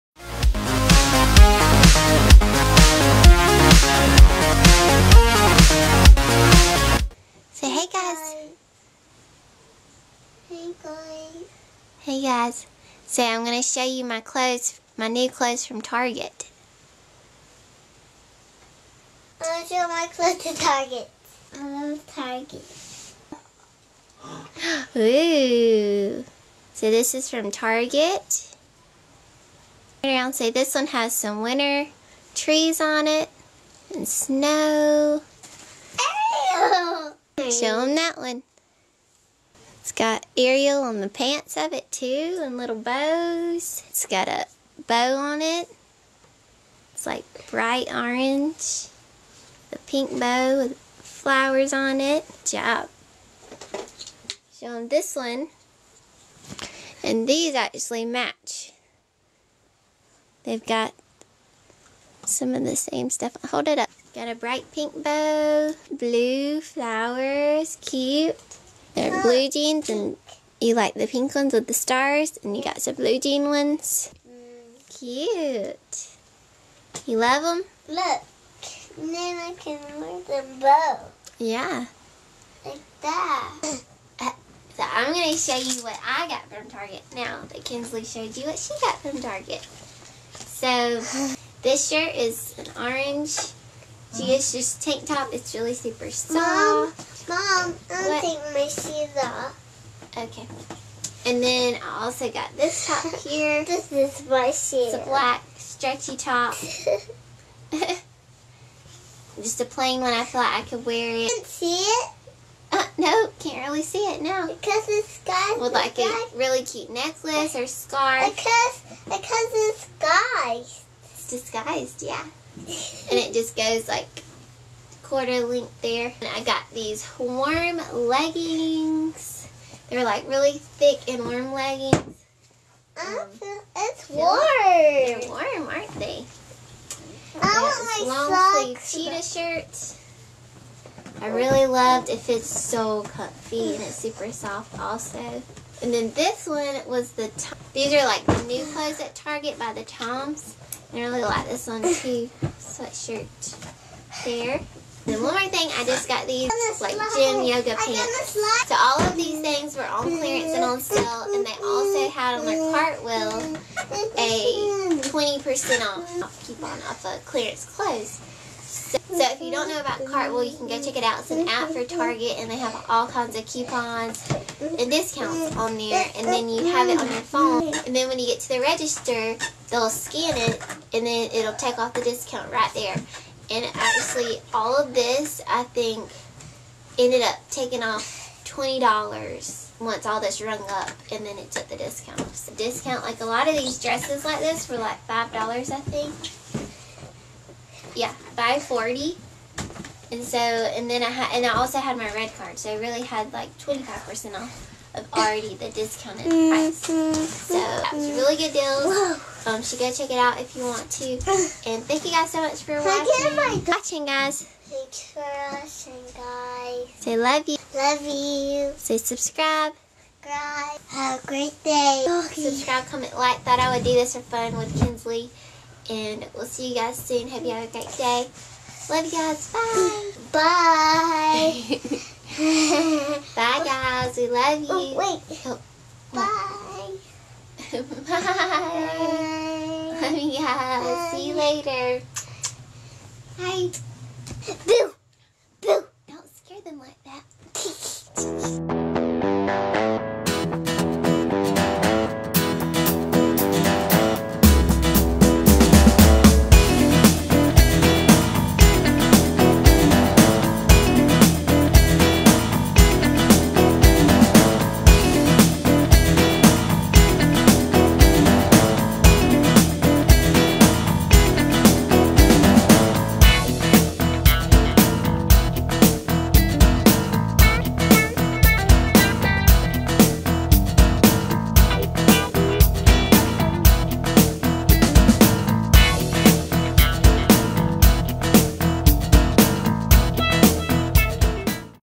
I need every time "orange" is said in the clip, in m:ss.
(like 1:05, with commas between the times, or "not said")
0:47, 1:32.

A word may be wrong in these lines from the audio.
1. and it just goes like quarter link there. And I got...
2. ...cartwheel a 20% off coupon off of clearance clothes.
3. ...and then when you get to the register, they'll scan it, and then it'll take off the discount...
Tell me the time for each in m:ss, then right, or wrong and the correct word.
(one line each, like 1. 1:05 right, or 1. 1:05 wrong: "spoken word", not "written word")
1. 2:03 right
2. 2:42 right
3. 2:57 right.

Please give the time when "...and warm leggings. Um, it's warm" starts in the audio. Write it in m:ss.
2:11.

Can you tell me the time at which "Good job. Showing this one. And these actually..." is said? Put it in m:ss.
0:52.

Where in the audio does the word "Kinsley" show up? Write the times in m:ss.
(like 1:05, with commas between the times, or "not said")
1:27, 3:44.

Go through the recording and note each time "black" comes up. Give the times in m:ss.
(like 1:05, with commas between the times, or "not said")
1:45.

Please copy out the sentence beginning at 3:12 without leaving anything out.
So discount like a lot of these dresses like this were like five dollars I think.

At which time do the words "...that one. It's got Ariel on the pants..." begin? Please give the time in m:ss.
0:37.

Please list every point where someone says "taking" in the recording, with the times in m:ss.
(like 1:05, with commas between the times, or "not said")
1:38, 3:07.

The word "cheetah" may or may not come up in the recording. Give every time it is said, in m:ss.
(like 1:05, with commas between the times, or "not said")
2:19.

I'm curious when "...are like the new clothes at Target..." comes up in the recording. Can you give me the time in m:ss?
2:27.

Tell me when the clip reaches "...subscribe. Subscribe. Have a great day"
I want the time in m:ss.
3:38.